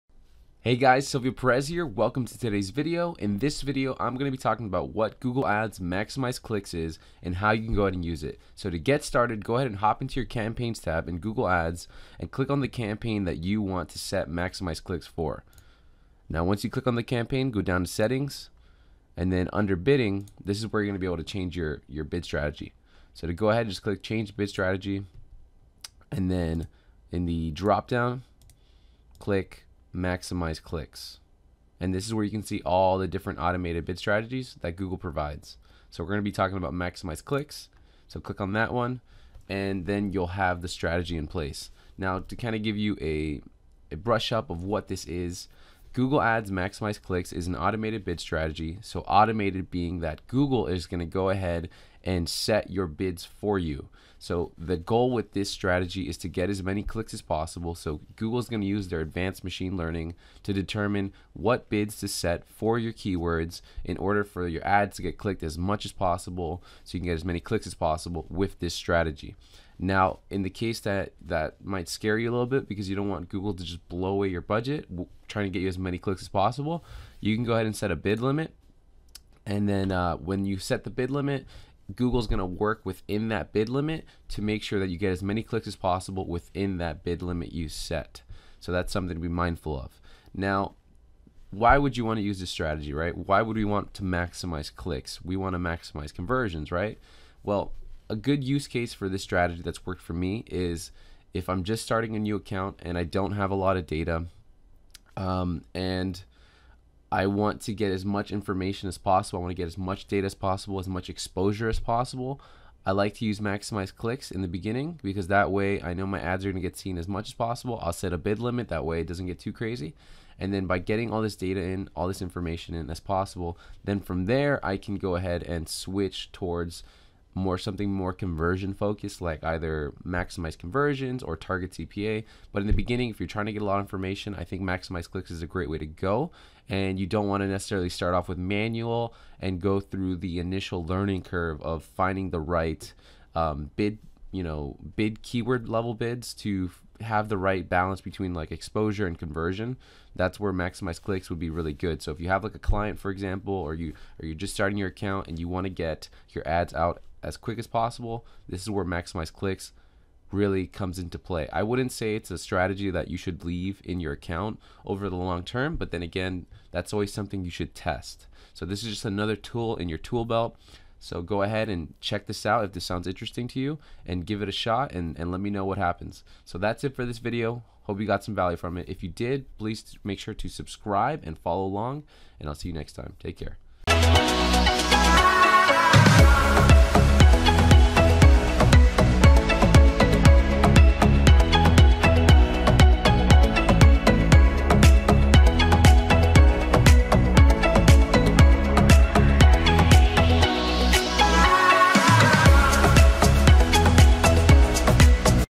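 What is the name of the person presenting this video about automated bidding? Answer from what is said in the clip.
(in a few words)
Silvio Perez.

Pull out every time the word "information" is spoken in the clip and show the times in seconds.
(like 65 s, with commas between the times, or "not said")
108 s, 122 s, 133 s.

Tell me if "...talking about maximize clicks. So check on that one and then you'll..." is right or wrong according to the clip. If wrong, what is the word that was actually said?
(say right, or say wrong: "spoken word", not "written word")
wrong: "click", not "check".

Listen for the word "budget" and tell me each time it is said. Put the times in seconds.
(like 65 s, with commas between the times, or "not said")
74 s.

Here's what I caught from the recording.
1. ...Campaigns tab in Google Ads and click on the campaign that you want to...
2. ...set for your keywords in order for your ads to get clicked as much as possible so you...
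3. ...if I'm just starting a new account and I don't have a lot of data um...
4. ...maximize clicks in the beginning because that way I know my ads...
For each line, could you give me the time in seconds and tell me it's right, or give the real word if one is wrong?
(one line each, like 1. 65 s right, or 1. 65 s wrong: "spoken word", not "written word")
1. 10 s right
2. 62 s right
3. 101 s right
4. 113 s right.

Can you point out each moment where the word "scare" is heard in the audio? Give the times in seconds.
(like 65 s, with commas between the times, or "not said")
71 s.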